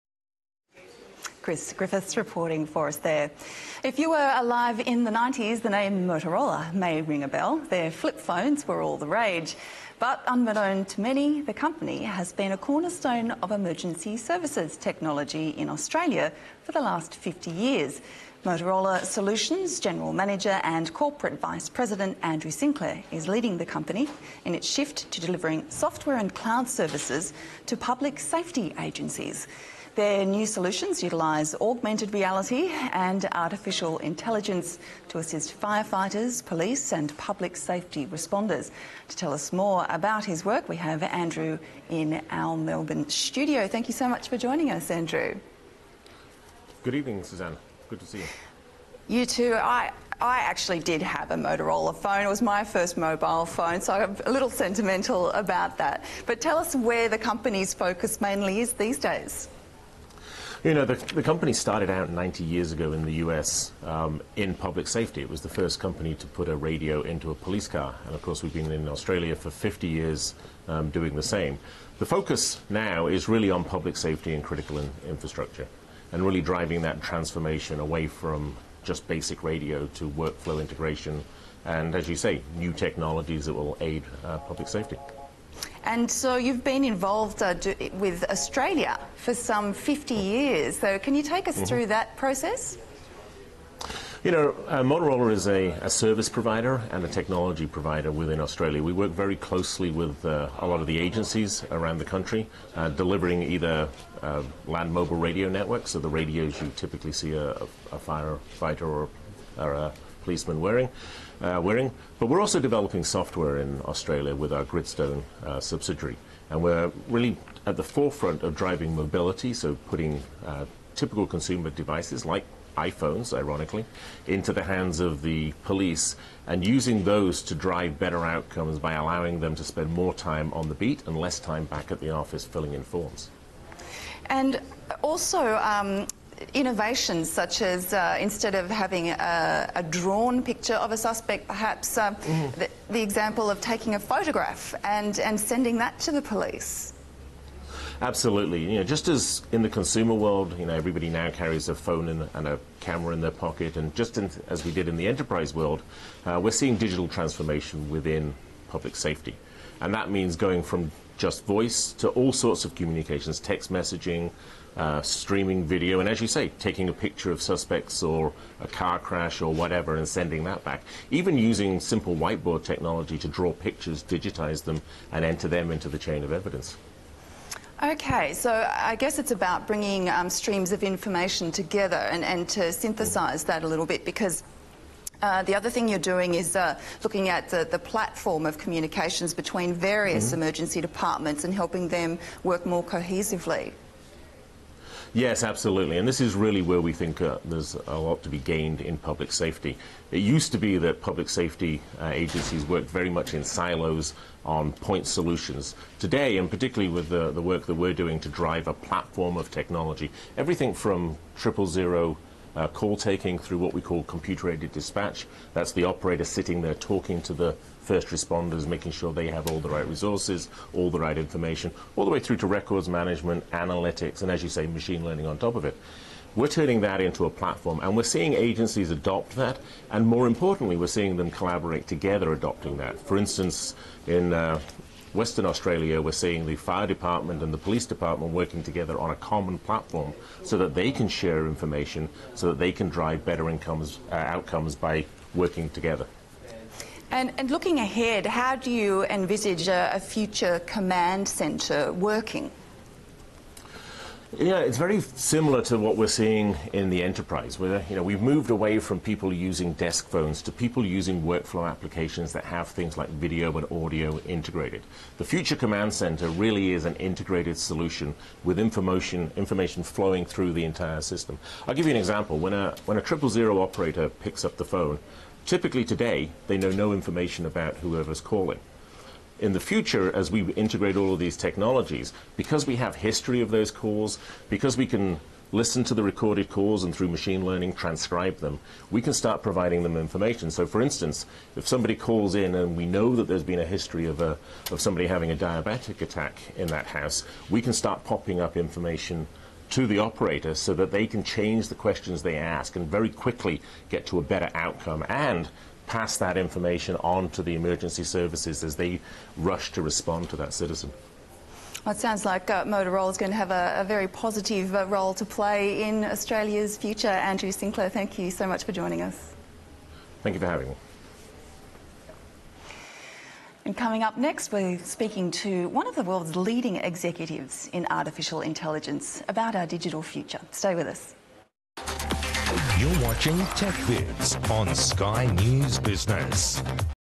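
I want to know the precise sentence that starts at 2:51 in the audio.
Even using simple whiteboard technology to draw pictures, digitize them, and enter them into the chain of evidence.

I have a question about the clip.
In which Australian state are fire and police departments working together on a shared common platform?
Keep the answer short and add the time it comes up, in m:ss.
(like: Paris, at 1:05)
Western Australia, at 3:55.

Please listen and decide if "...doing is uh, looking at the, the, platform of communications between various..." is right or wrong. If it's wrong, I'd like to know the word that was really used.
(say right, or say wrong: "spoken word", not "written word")
right.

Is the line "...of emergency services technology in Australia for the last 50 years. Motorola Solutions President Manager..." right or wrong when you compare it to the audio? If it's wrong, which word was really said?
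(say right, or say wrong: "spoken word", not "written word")
wrong: "General", not "President".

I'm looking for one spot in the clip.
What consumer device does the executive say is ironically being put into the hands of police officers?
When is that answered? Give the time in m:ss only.
2:02.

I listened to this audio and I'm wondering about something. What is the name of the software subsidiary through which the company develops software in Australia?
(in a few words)
Gridstone.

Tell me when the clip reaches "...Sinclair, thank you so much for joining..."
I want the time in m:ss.
5:17.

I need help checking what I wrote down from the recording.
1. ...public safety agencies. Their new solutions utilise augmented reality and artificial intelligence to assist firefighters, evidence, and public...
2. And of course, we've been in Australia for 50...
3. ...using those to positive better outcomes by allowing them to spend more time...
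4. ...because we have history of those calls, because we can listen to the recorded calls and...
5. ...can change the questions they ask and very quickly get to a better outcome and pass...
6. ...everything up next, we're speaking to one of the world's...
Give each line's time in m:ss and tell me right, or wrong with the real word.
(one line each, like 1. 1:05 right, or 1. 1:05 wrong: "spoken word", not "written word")
1. 0:27 wrong: "police", not "evidence"
2. 1:08 right
3. 2:06 wrong: "drive", not "positive"
4. 4:42 right
5. 5:01 right
6. 5:23 wrong: "coming", not "everything".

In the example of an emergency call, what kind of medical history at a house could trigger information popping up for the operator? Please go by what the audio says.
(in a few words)
diabetic attack.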